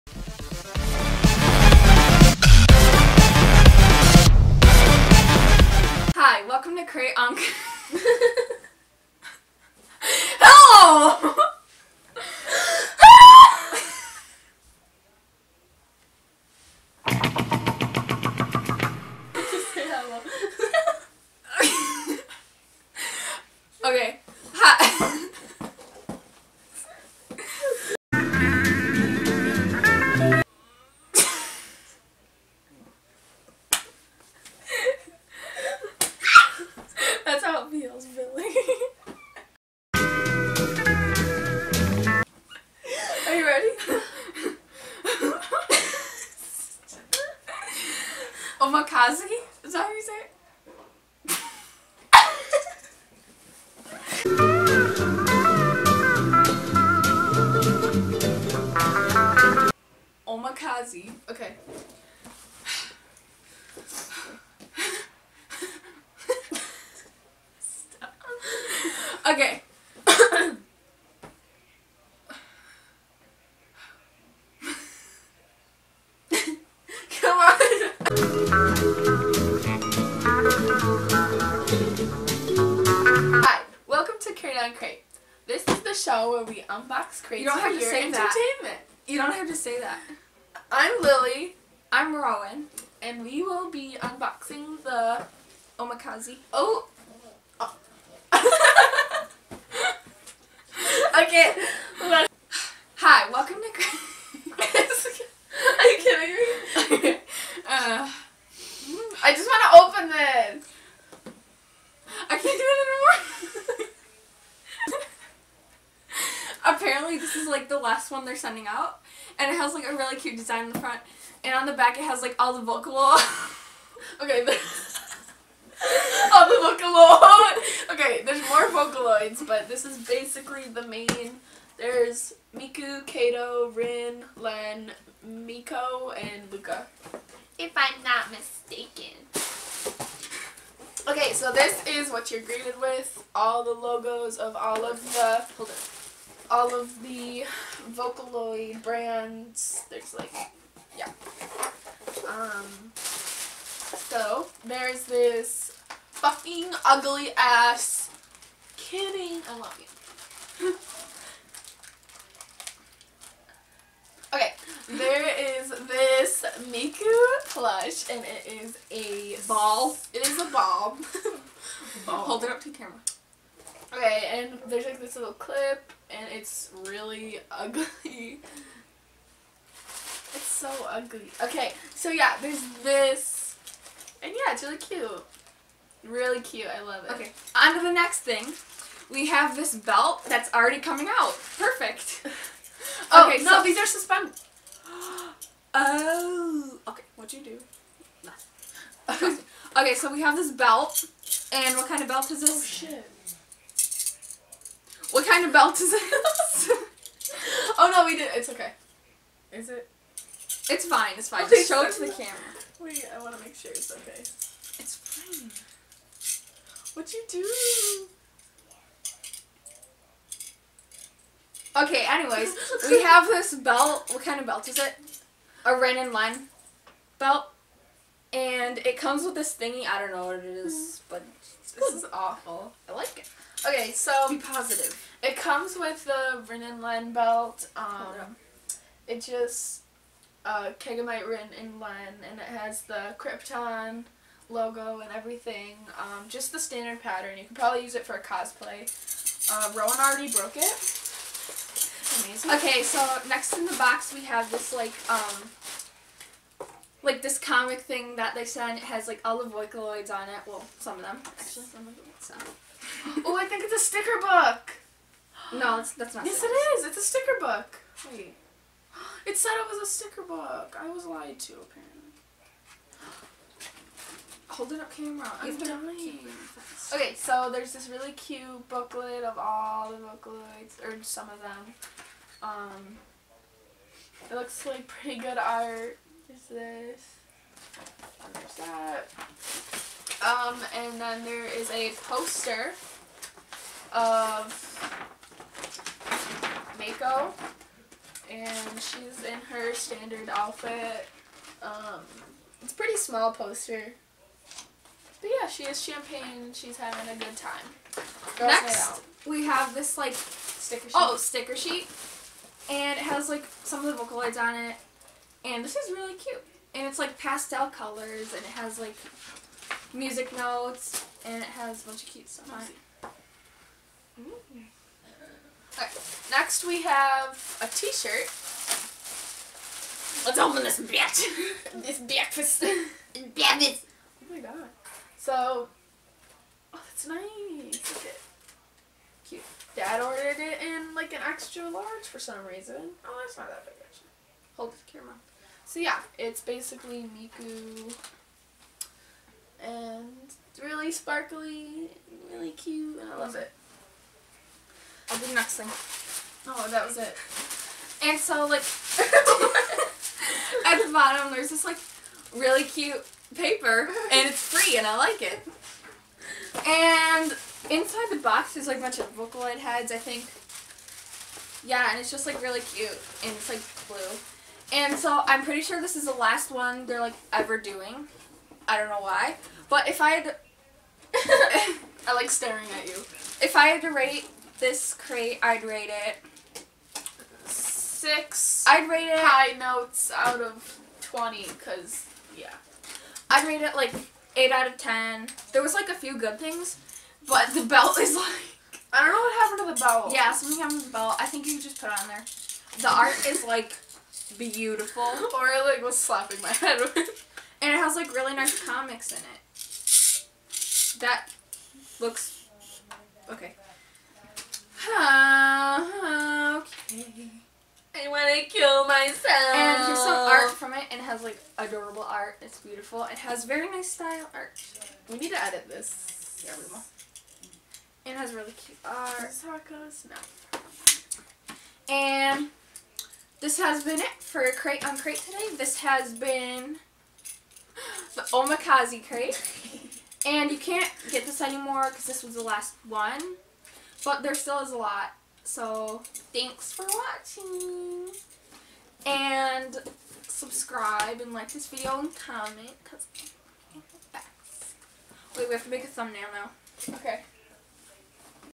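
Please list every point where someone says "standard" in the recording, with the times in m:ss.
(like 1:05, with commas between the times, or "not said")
4:06, 4:59.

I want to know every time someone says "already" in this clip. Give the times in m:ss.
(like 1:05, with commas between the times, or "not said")
3:10, 4:09.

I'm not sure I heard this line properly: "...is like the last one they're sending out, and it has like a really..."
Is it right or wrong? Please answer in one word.
right.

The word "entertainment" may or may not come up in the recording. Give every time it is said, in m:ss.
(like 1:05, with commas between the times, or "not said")
1:28.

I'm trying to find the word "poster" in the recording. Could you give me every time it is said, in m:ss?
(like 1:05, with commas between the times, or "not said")
4:52, 5:03.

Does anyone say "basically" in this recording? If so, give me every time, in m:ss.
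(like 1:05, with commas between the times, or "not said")
2:10, 5:46.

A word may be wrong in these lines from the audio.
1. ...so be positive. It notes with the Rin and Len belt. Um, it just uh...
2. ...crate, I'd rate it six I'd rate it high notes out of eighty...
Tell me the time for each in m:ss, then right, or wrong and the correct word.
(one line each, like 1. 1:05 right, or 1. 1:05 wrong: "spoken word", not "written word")
1. 3:53 wrong: "comes", not "notes"
2. 6:24 wrong: "twenty", not "eighty".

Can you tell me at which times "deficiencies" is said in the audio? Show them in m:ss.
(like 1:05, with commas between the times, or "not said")
not said.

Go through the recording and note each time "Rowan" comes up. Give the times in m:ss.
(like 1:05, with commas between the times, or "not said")
1:32, 4:09.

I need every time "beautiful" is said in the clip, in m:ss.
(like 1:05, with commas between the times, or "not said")
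6:44, 7:02.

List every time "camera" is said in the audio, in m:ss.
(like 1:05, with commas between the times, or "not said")
2:52, 3:32, 4:34, 5:44.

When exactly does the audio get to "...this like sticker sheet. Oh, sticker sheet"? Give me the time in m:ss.
5:09.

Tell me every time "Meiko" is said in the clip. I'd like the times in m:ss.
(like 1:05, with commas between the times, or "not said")
2:15, 4:56.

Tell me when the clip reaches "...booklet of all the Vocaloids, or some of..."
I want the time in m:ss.
4:38.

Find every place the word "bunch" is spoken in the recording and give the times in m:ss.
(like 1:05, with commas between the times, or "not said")
5:21, 6:08.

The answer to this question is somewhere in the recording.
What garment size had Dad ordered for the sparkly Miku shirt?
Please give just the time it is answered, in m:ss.
5:41.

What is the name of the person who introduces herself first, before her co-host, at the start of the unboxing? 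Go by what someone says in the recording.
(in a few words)
Lily.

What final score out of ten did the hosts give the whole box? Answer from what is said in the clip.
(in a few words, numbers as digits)
8.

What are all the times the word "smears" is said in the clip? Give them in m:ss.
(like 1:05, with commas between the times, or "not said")
not said.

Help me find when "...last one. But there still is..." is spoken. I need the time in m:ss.
7:22.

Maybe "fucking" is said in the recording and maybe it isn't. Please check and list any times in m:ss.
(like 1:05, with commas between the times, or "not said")
2:36.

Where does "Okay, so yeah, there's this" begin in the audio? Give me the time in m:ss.
3:01.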